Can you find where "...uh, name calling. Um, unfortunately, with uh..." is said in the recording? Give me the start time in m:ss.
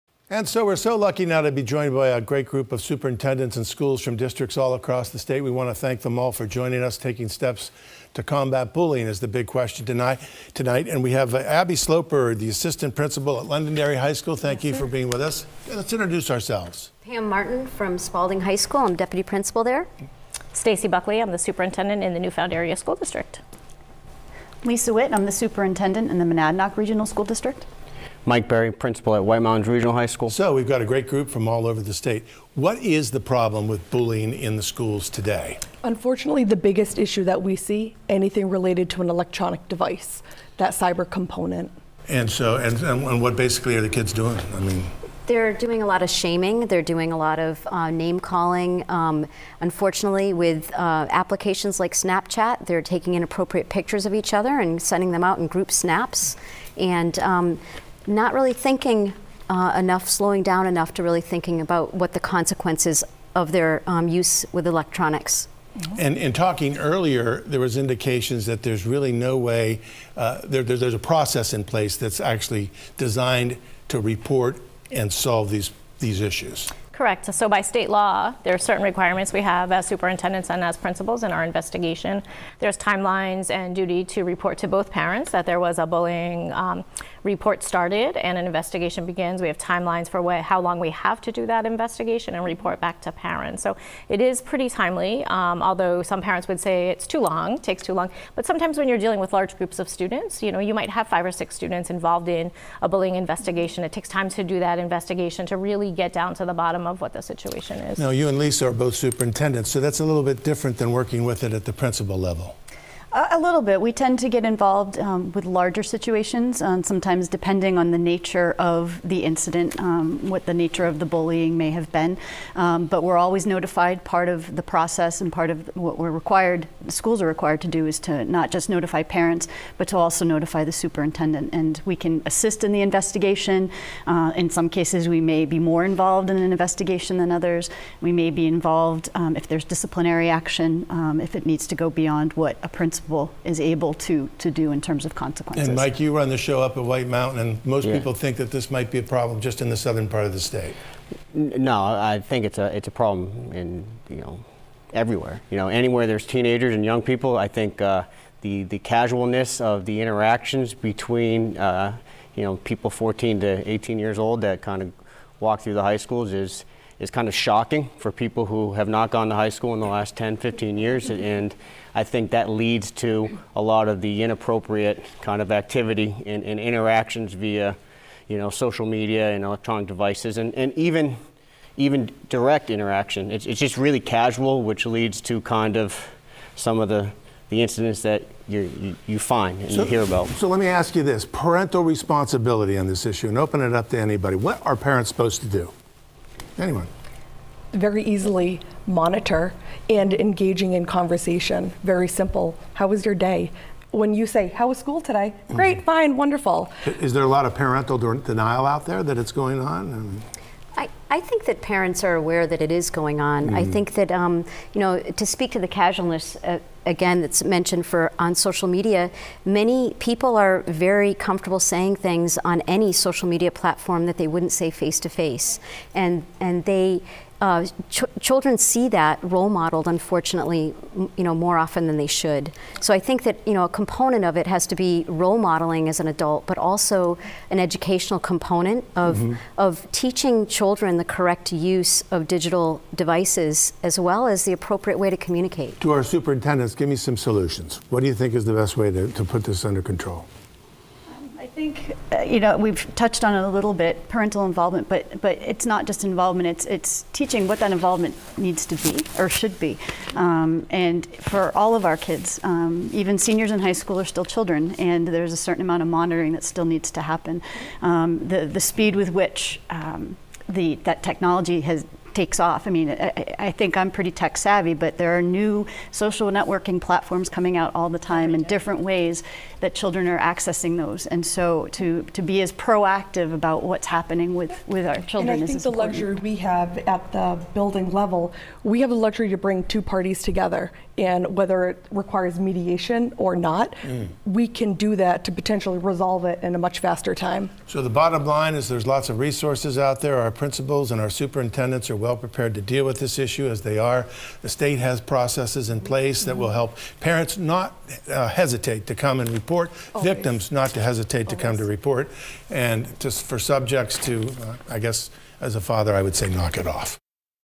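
0:47.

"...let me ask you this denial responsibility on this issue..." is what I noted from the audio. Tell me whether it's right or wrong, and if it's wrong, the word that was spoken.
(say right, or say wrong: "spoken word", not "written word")
wrong: "parental", not "denial".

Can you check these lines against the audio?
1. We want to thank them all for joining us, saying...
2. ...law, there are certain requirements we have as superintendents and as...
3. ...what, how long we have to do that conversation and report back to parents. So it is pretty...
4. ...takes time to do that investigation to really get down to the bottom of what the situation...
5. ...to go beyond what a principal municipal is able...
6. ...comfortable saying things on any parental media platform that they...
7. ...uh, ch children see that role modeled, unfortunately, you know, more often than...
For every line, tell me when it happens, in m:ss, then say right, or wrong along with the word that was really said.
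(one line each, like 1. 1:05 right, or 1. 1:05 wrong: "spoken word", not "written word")
1. 0:05 wrong: "taking", not "saying"
2. 1:17 right
3. 1:30 wrong: "investigation", not "conversation"
4. 1:43 right
5. 2:21 right
6. 3:41 wrong: "social", not "parental"
7. 3:47 right.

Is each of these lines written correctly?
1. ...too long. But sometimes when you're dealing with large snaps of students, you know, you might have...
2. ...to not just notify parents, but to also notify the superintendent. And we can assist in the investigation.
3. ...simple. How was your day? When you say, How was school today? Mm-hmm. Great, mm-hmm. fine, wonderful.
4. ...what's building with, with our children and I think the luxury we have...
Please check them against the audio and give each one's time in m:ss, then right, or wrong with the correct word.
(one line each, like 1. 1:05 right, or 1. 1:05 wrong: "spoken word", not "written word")
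1. 1:37 wrong: "groups", not "snaps"
2. 2:07 right
3. 3:22 right
4. 4:43 wrong: "happening", not "building".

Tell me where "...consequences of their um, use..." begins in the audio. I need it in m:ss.
1:02.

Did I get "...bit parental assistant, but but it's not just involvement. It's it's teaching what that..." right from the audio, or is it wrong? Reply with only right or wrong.
wrong.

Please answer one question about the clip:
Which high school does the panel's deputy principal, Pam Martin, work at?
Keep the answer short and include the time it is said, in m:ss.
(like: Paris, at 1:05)
Spaulding High School, at 0:17.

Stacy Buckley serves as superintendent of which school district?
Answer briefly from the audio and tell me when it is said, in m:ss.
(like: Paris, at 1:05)
Newfound Area School District, at 0:22.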